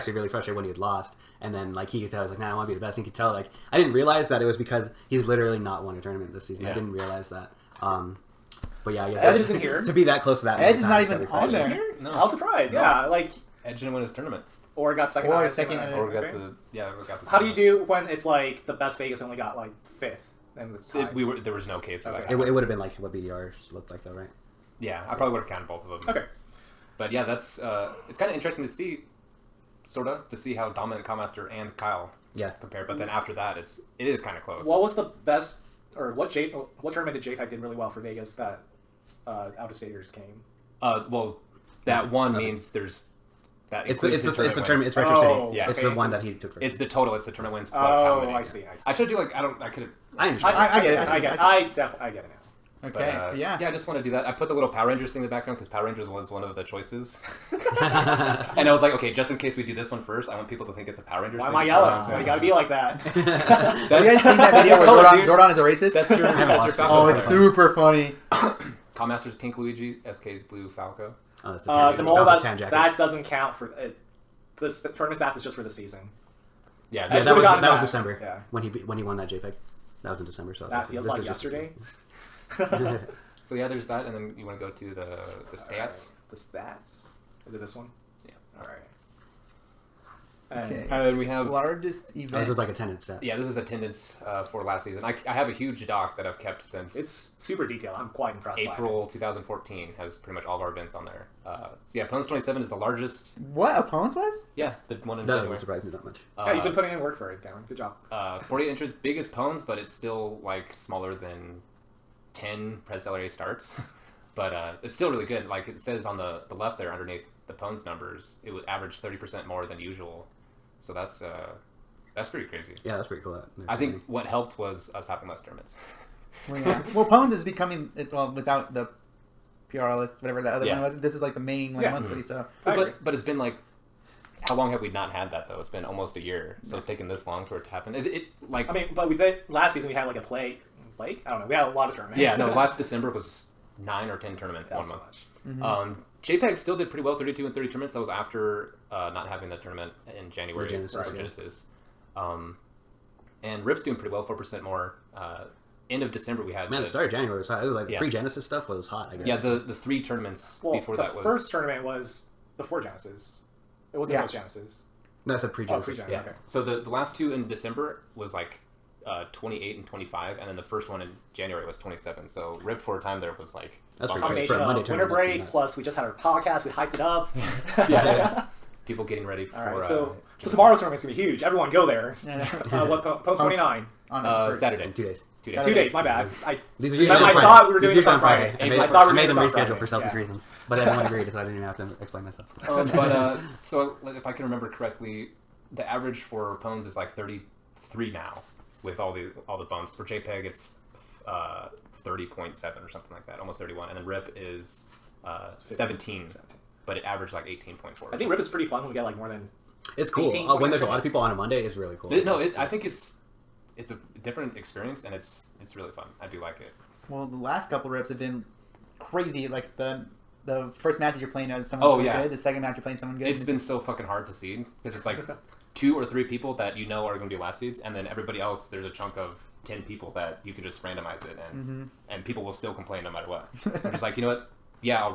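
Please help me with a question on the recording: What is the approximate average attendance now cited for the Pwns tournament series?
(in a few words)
33.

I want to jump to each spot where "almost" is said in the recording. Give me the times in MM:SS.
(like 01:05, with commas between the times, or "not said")
02:15, 03:23.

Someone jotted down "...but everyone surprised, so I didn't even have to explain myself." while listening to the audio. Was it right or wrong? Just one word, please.
wrong.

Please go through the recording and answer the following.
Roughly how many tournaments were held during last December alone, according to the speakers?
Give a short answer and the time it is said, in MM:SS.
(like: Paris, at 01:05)
9 or 10, at 02:23.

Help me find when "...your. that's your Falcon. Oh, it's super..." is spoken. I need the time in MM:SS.
01:06.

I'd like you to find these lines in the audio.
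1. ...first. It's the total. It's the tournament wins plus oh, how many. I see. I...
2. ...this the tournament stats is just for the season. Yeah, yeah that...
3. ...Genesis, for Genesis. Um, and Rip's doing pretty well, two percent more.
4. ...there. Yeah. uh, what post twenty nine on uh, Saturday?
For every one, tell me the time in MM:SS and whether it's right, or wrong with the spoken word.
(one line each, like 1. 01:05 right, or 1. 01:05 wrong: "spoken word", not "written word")
1. 00:46 right
2. 01:14 right
3. 02:30 wrong: "four", not "two"
4. 03:01 right.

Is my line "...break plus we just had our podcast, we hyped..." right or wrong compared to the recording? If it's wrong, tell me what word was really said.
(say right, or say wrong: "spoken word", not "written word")
right.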